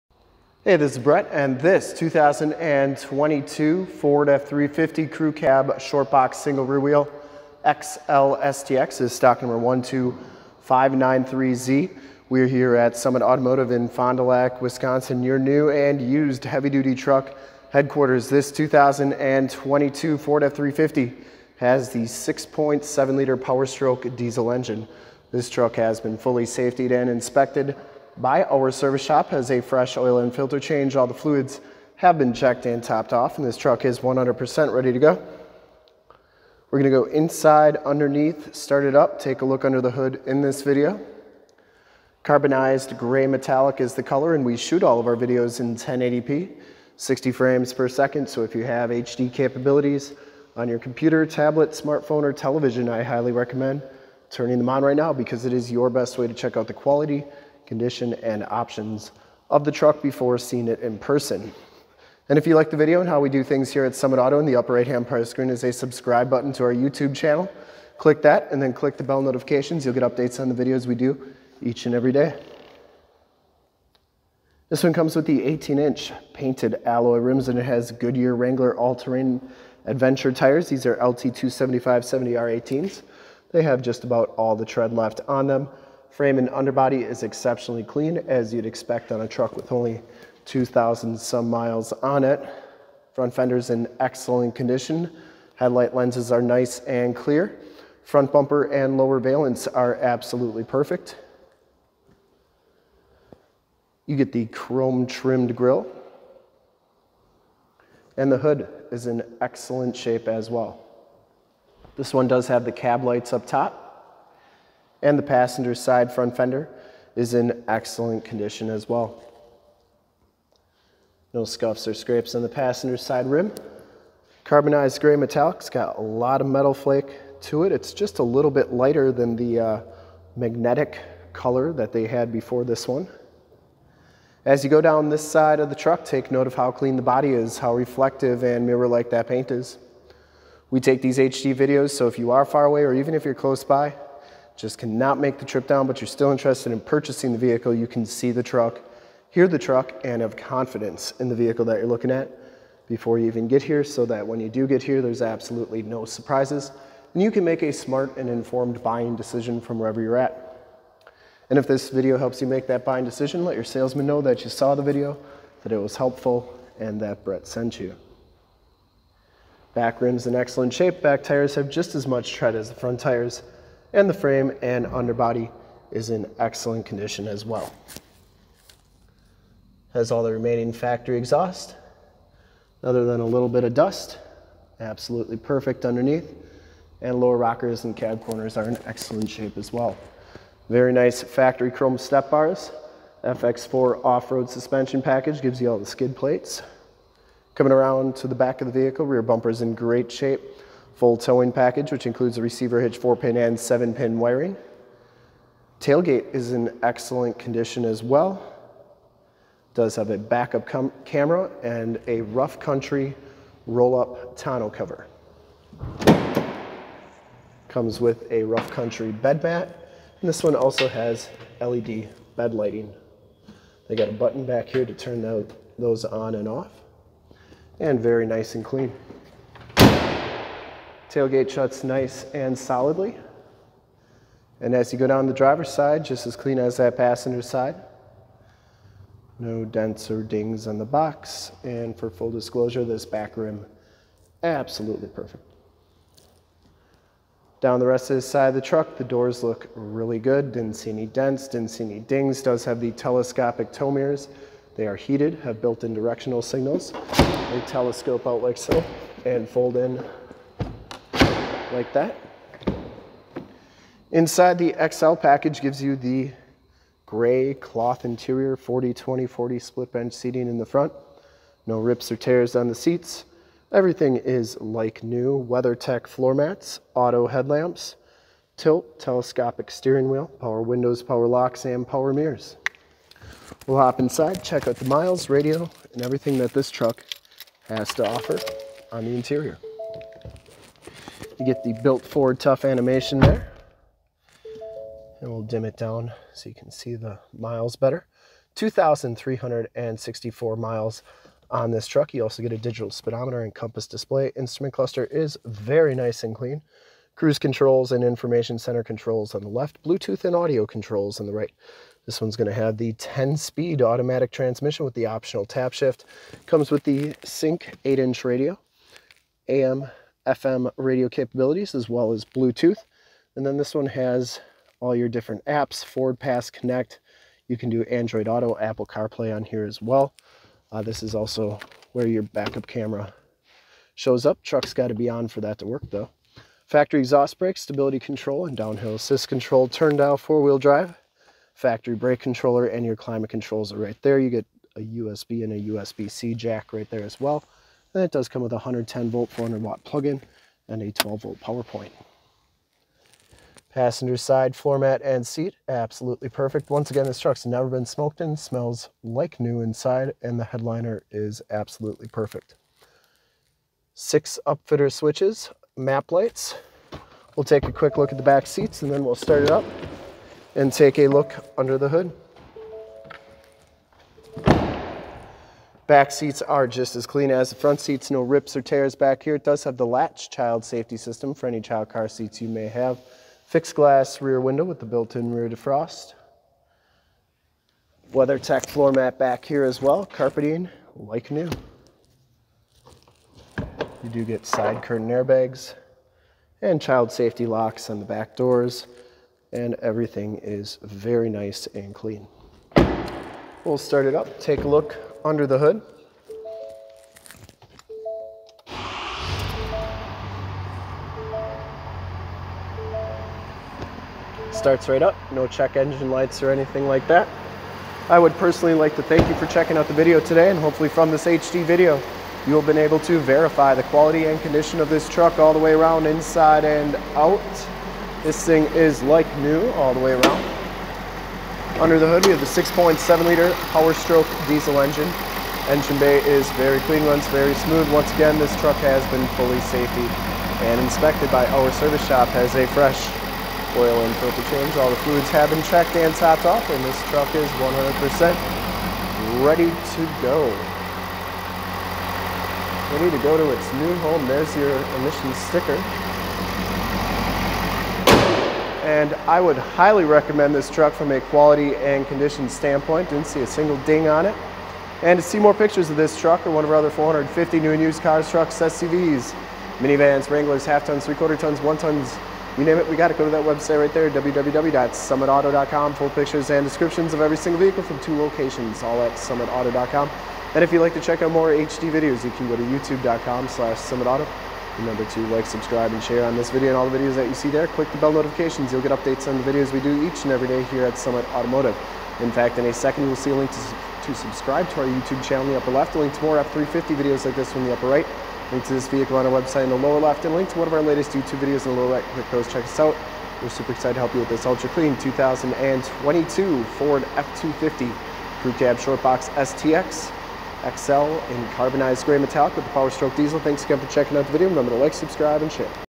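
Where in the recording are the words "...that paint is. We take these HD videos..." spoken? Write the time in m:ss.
2:19.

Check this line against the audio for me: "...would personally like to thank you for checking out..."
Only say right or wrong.
right.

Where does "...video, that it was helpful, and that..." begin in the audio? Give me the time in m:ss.
2:44.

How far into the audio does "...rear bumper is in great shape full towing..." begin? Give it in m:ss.
3:19.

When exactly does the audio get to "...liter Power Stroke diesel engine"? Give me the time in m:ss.
7:13.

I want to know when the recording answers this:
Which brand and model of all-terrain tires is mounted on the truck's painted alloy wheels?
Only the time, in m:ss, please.
1:17.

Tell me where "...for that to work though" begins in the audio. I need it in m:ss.
5:35.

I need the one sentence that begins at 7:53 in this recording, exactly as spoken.
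Go to that website right there, www.summitauto.com.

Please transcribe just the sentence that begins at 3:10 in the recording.
Very nice factory chrome step bars.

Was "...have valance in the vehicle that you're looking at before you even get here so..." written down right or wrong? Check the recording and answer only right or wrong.
wrong.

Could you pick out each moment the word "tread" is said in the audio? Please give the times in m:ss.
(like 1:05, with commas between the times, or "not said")
1:24, 2:52.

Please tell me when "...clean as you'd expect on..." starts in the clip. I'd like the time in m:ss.
1:27.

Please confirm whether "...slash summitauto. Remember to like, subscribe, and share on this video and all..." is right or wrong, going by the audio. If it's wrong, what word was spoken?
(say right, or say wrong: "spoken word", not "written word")
right.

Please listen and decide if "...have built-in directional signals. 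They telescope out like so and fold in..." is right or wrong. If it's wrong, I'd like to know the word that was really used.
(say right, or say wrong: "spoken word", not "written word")
right.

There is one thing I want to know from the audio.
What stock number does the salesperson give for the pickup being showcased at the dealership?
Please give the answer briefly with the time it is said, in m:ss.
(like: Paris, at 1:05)
12593Z, at 0:09.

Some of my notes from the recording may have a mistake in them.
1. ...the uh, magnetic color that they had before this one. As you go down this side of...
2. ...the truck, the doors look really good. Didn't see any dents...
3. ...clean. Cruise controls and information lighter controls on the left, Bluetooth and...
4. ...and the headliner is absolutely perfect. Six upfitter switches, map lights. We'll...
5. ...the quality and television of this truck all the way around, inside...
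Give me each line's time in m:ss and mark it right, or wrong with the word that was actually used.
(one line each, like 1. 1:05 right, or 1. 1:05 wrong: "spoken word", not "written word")
1. 2:09 right
2. 4:08 right
3. 5:06 wrong: "center", not "lighter"
4. 6:00 right
5. 7:03 wrong: "condition", not "television".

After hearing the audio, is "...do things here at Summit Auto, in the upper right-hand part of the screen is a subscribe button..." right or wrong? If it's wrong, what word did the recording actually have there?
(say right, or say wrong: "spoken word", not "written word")
right.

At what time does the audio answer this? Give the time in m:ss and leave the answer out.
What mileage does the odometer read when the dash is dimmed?
4:58.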